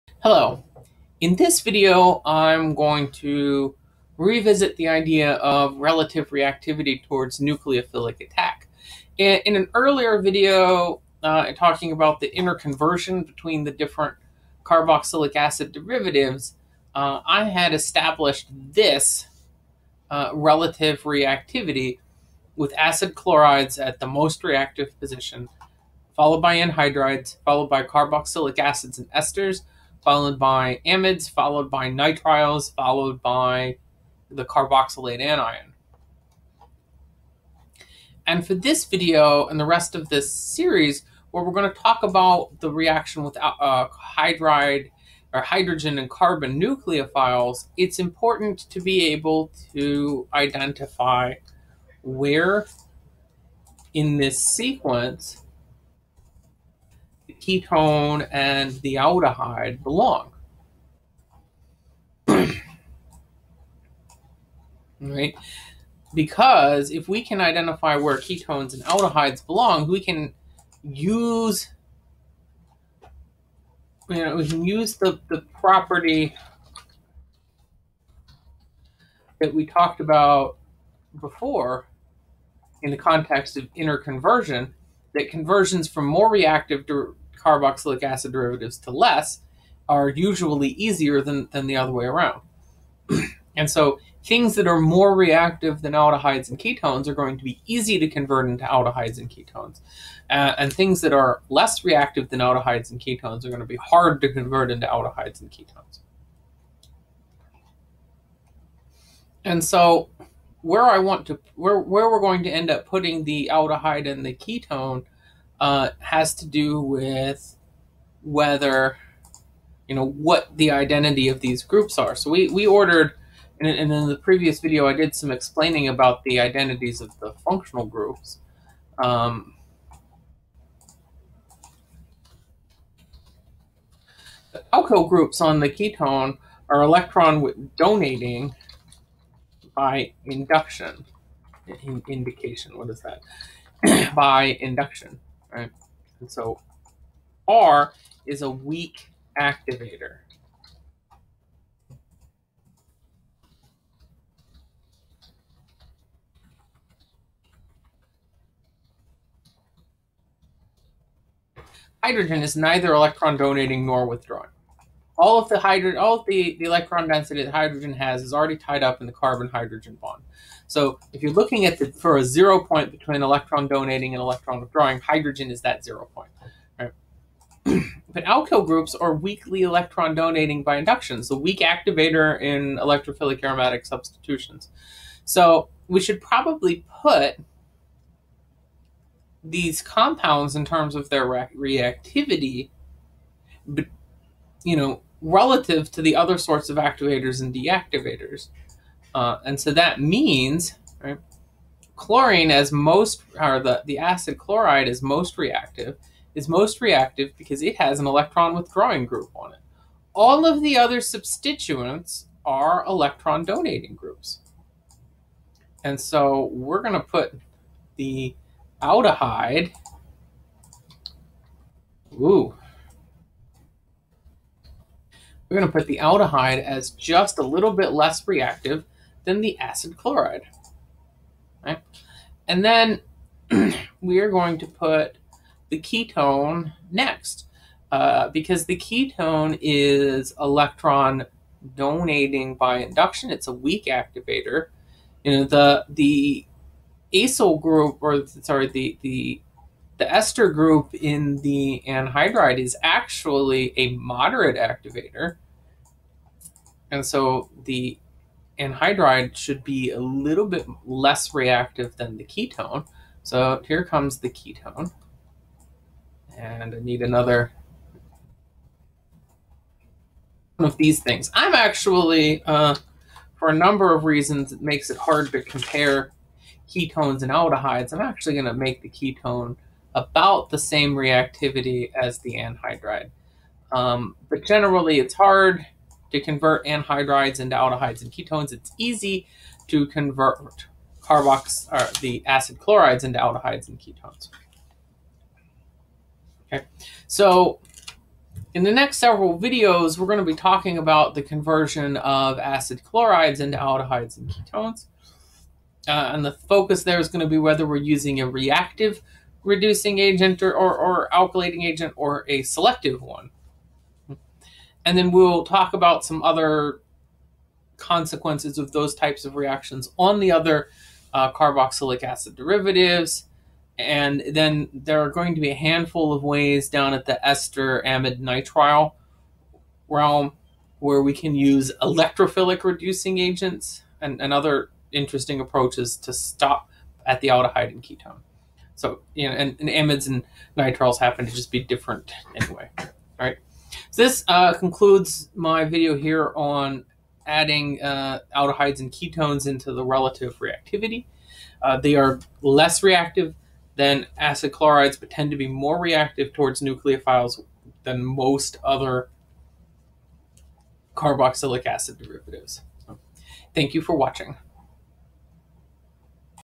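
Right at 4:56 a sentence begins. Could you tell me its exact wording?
Okay, so in the next several videos, we're going to be talking about the conversion of acid chlorides into aldehydes and ketones.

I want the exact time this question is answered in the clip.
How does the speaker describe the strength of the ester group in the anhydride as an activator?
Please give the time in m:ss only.
4:13.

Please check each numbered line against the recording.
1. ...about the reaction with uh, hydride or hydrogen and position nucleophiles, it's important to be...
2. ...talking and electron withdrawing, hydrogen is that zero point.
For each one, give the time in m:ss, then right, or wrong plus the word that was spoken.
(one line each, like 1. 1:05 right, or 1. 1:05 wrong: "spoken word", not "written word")
1. 0:42 wrong: "carbon", not "position"
2. 2:53 wrong: "donating", not "talking".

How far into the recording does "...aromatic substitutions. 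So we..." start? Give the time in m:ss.
3:03.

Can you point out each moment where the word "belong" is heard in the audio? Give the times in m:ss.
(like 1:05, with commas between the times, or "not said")
0:59, 1:09.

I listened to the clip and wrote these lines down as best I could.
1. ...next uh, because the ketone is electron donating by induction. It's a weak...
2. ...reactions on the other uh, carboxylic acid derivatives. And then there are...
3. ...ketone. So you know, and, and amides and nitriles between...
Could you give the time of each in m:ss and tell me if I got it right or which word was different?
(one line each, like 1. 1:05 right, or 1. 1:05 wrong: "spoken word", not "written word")
1. 3:56 right
2. 5:19 right
3. 5:37 wrong: "happen", not "between".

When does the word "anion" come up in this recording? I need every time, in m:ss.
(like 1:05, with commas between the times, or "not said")
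0:35.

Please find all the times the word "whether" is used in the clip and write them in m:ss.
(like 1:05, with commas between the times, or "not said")
1:58, 5:07.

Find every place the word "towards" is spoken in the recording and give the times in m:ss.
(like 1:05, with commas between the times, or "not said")
0:07, 5:56.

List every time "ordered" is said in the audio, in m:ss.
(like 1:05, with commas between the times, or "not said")
2:02.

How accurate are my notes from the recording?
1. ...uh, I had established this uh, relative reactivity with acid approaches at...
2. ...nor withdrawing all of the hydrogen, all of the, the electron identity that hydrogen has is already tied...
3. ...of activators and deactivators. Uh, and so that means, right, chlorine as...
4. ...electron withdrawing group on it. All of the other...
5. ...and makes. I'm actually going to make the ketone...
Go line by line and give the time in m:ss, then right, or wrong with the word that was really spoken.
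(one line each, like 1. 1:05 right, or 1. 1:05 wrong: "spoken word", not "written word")
1. 0:16 wrong: "chlorides", not "approaches"
2. 2:43 wrong: "density", not "identity"
3. 3:16 right
4. 3:28 right
5. 4:37 wrong: "aldehydes", not "makes".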